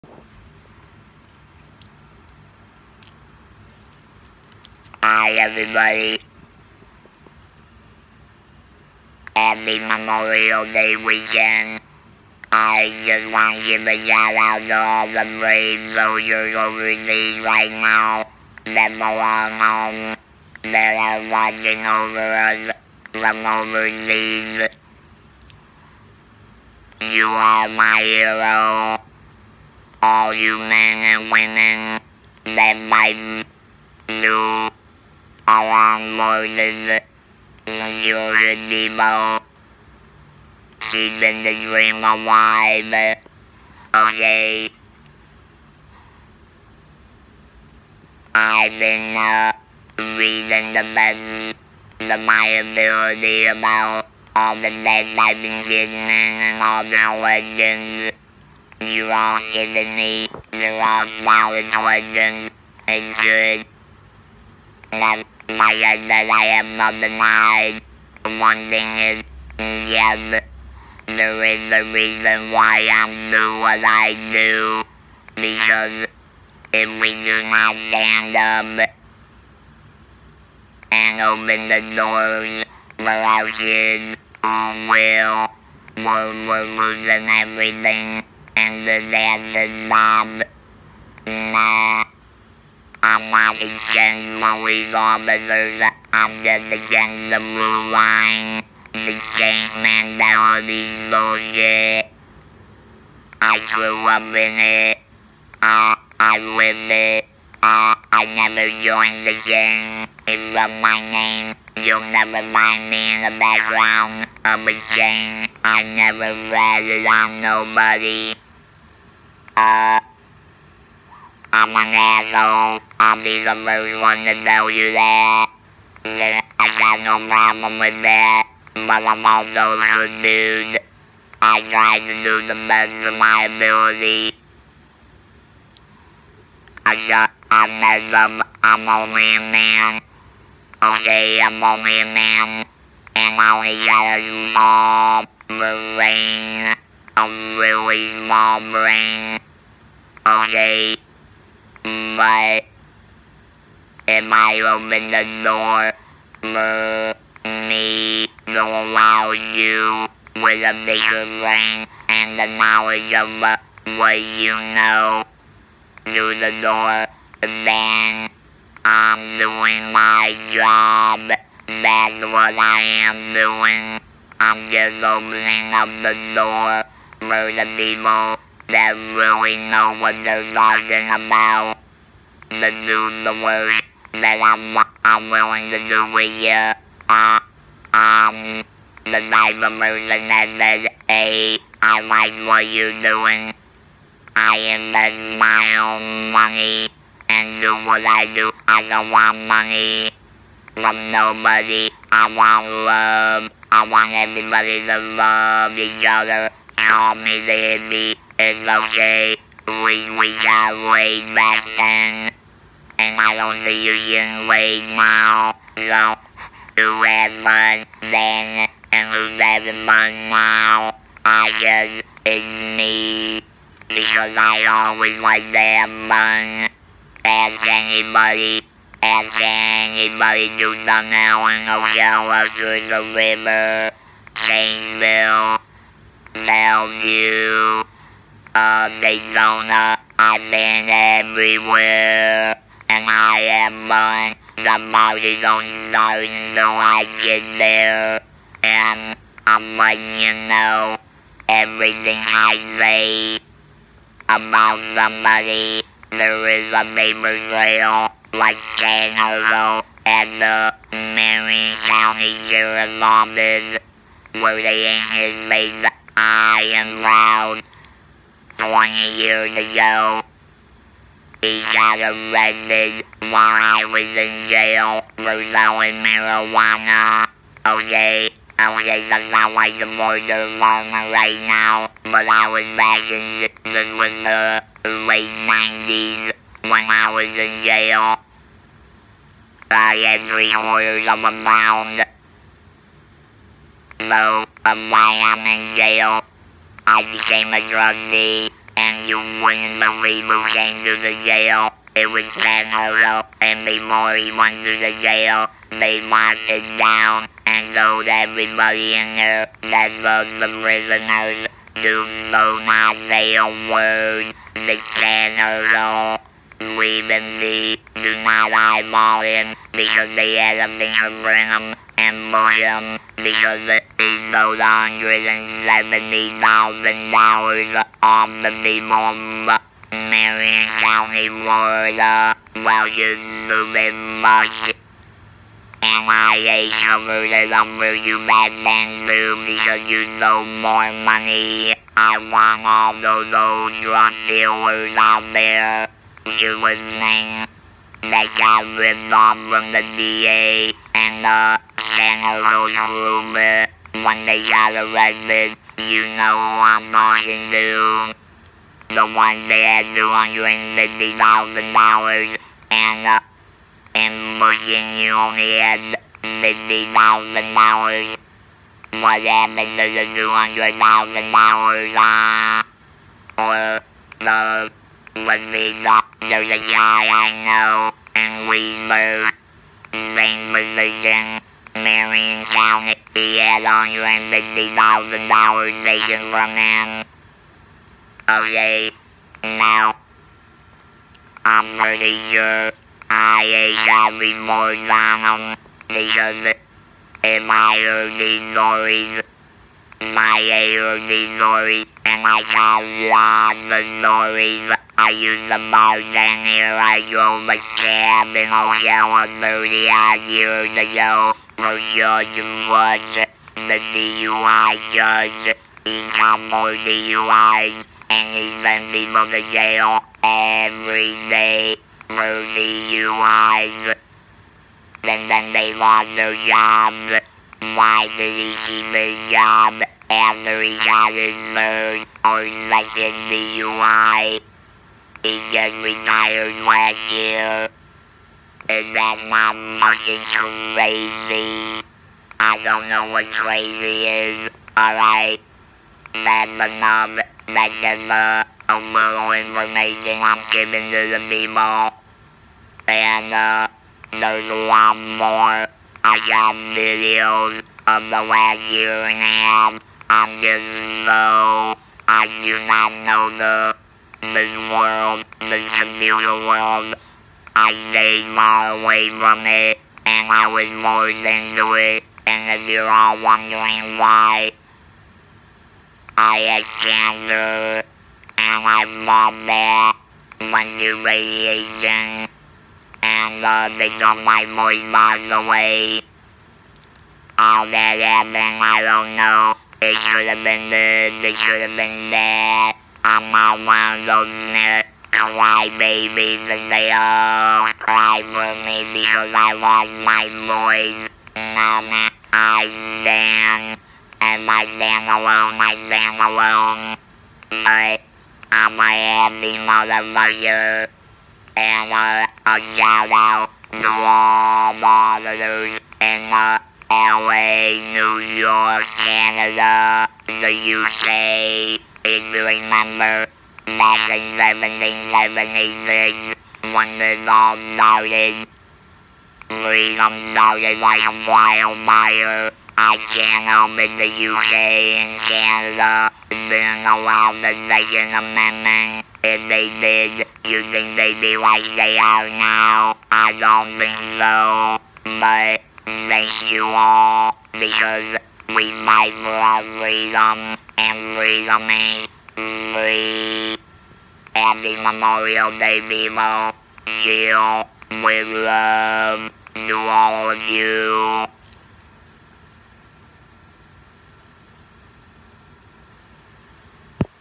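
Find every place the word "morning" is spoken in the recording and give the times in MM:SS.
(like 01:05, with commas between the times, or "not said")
00:36, 08:43.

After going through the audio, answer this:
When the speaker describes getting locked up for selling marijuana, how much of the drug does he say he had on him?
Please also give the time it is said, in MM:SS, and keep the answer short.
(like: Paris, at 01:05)
3/4 of a pound, at 04:50.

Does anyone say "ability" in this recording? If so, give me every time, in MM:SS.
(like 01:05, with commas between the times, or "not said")
00:52, 02:13.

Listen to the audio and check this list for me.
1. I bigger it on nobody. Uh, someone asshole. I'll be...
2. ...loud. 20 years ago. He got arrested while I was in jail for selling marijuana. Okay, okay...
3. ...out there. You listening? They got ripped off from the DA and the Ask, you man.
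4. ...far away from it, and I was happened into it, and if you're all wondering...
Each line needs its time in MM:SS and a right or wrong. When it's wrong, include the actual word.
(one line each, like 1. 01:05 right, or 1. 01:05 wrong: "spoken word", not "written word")
1. 01:55 wrong: "never", not "bigger"
2. 04:27 right
3. 05:44 wrong: "Hello", not "Ask"
4. 07:48 wrong: "forced", not "happened".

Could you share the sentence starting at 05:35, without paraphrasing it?
And I covered it up for you back then too because you stole more money.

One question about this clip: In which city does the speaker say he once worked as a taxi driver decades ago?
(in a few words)
Ocala.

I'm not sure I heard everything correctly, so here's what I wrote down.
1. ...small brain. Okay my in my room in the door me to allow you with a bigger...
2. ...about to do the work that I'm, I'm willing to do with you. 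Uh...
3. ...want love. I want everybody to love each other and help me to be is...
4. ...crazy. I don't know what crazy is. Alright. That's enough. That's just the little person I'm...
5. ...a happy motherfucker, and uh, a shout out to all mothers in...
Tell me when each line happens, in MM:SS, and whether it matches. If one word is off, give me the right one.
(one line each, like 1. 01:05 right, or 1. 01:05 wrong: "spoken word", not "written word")
1. 02:28 right
2. 03:01 right
3. 03:22 right
4. 07:20 wrong: "information", not "person"
5. 08:28 right.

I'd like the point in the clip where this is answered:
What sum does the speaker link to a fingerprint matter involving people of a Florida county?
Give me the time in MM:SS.
05:24.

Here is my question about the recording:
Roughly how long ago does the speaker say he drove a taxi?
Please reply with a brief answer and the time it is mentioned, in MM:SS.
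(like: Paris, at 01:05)
30 odd years ago, at 06:49.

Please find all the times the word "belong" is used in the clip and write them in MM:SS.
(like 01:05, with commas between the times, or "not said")
00:19.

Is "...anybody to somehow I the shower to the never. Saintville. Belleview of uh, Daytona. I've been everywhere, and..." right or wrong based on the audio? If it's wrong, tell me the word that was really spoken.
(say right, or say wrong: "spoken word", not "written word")
wrong: "river", not "never".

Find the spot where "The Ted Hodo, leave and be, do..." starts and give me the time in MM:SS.
05:14.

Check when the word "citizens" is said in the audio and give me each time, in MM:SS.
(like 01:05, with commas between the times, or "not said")
not said.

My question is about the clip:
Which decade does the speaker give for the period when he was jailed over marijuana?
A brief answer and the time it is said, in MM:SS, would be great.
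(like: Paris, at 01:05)
late 90s, at 04:45.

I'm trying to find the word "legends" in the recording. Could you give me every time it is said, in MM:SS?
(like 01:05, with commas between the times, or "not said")
00:57, 01:01.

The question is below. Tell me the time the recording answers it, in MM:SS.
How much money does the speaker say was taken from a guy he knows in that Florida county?
06:23.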